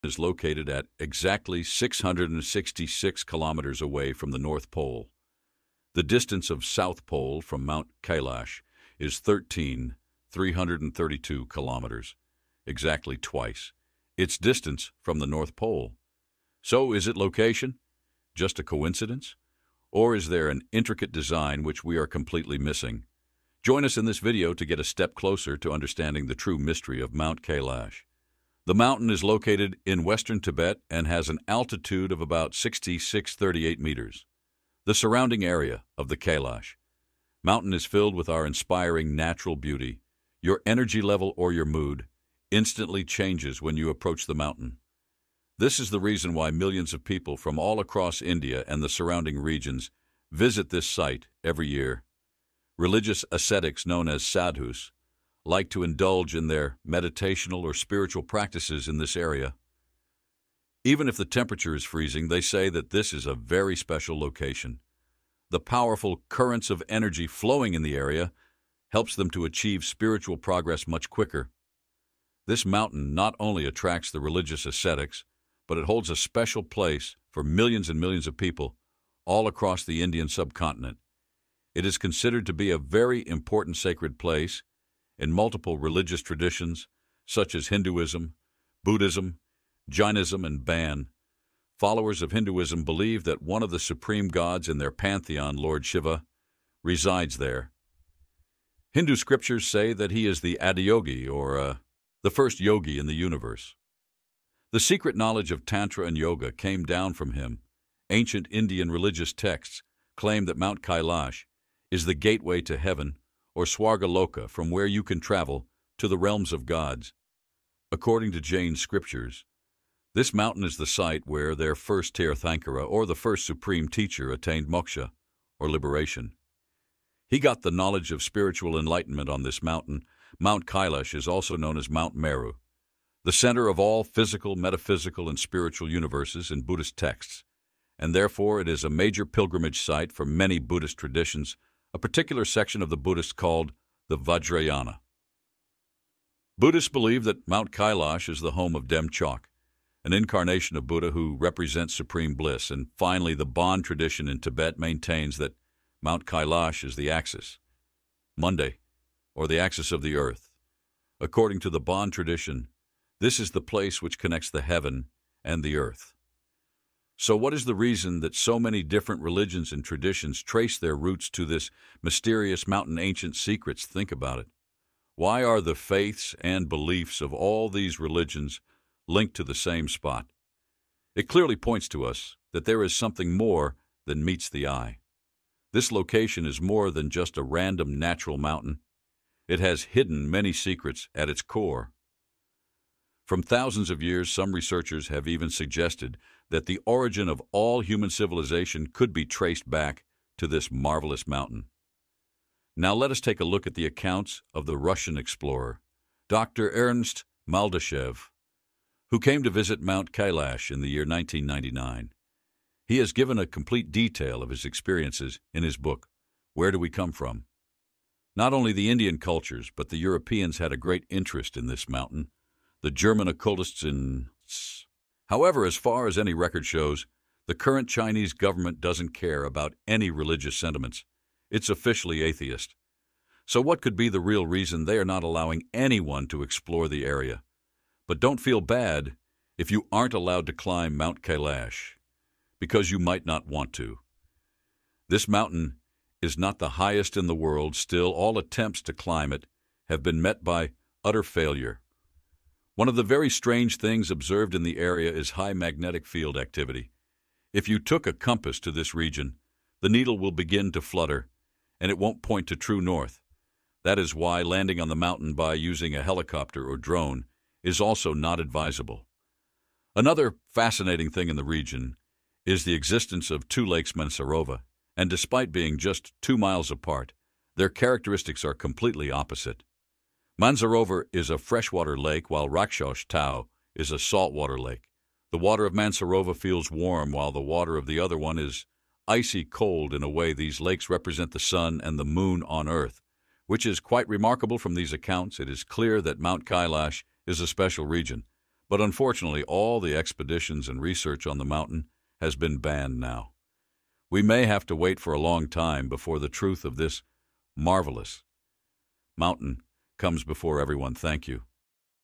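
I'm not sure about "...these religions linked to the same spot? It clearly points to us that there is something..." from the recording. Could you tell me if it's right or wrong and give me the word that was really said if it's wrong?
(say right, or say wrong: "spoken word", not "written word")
right.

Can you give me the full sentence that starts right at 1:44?
The secret knowledge of Tantra and Yoga came down from him.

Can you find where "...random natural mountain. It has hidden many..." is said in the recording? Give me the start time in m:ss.
3:07.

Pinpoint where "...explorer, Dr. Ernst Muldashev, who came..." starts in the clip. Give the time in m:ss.
3:25.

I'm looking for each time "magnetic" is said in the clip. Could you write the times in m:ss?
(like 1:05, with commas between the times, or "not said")
4:15.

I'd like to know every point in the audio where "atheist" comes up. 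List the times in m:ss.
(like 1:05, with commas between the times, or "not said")
3:52.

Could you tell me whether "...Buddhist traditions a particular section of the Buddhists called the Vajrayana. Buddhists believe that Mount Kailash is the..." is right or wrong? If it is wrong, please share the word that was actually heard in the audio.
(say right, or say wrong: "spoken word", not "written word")
right.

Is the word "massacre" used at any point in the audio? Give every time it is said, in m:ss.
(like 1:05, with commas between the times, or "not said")
not said.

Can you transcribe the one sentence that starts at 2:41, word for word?
According to the Bon tradition, this is the place which connects the heaven and the earth.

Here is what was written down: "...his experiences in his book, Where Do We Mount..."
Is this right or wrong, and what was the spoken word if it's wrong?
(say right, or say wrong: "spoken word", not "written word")
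wrong: "Come", not "Mount".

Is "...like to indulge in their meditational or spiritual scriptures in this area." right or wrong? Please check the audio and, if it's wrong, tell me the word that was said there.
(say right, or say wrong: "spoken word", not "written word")
wrong: "practices", not "scriptures".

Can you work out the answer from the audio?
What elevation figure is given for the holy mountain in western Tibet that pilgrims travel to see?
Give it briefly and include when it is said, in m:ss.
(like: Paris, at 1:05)
6638 meters, at 0:32.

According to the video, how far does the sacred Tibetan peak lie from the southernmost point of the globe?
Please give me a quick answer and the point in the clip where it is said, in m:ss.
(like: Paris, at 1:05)
13,332 kilometers, at 0:09.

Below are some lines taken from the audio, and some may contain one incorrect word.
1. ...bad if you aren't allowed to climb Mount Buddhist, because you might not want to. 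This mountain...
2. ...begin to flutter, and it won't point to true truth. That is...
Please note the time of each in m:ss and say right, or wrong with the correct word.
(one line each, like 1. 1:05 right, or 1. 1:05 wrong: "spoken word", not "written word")
1. 3:58 wrong: "Kailash", not "Buddhist"
2. 4:20 wrong: "north", not "truth".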